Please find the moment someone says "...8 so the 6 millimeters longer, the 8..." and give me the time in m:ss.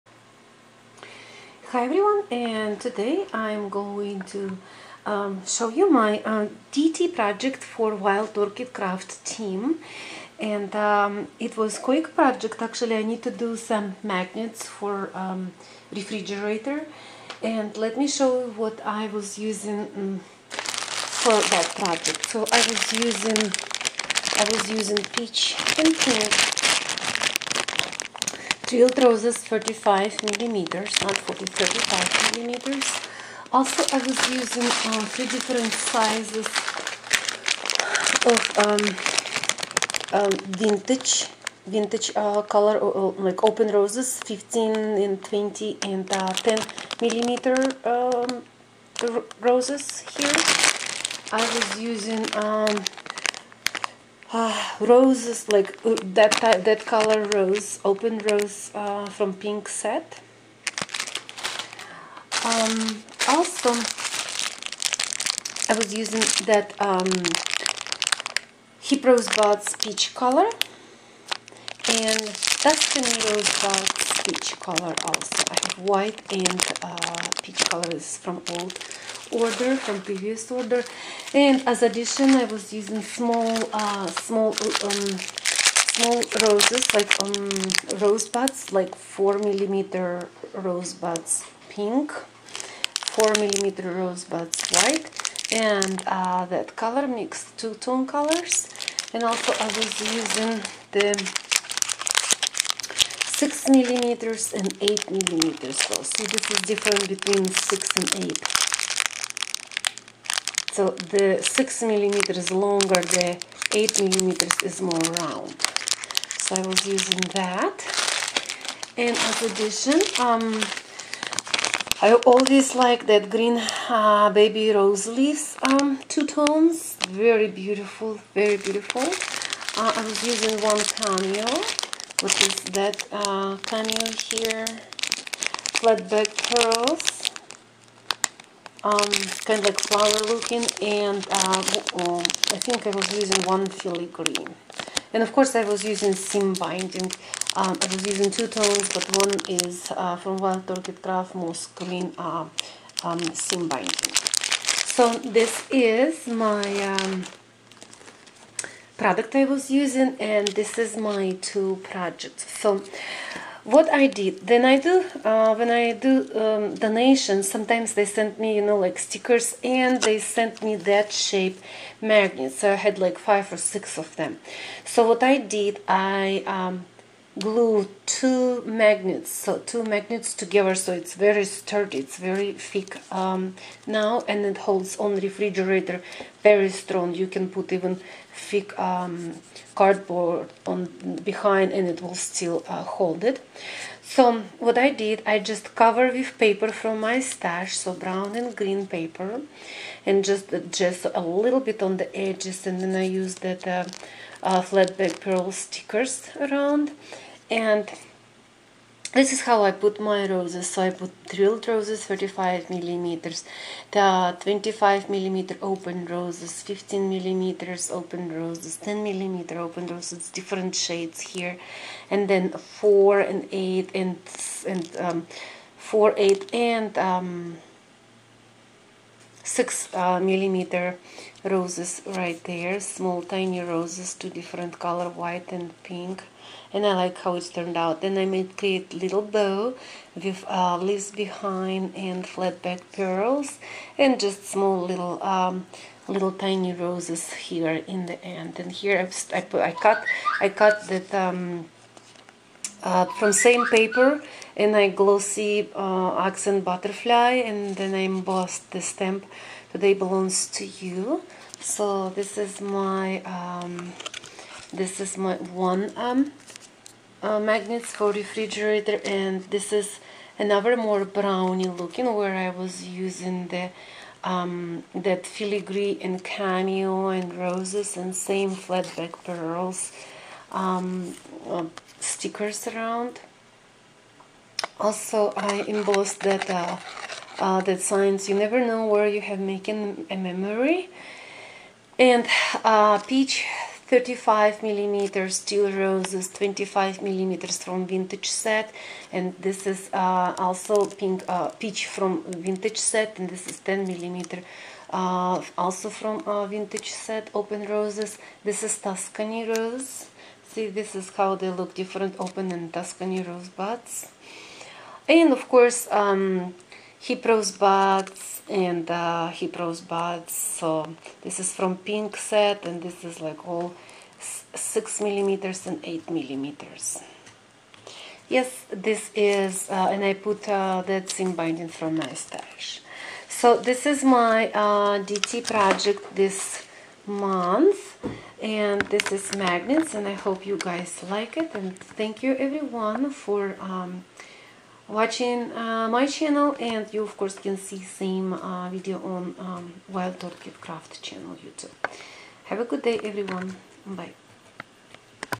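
1:48.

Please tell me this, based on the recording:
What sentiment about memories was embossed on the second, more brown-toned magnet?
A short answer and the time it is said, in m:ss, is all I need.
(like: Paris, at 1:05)
You never know where you have making a memory, at 4:48.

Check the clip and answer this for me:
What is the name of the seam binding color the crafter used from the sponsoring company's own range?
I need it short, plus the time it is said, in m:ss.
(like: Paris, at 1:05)
Moss Green, at 2:31.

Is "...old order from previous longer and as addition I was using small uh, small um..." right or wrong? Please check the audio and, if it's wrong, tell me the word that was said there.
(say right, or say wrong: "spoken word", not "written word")
wrong: "order", not "longer".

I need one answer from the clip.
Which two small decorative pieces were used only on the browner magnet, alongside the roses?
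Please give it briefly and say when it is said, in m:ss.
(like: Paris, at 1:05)
filigree and cameo, at 4:35.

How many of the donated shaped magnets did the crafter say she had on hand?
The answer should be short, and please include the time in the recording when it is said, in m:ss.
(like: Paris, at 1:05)
five or six, at 2:53.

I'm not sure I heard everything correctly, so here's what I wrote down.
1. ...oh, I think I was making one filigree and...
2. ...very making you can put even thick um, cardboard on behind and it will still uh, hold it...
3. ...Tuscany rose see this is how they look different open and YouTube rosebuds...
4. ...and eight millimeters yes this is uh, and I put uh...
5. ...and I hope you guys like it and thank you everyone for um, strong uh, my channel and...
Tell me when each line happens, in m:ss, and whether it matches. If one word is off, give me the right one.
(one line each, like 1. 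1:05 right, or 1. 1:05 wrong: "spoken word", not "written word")
1. 2:21 wrong: "using", not "making"
2. 3:06 wrong: "strong", not "making"
3. 5:08 wrong: "Tuscany", not "YouTube"
4. 5:25 right
5. 5:39 wrong: "watching", not "strong".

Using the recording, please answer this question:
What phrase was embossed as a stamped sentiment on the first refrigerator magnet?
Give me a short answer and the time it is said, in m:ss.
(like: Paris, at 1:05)
today belongs to you, at 4:19.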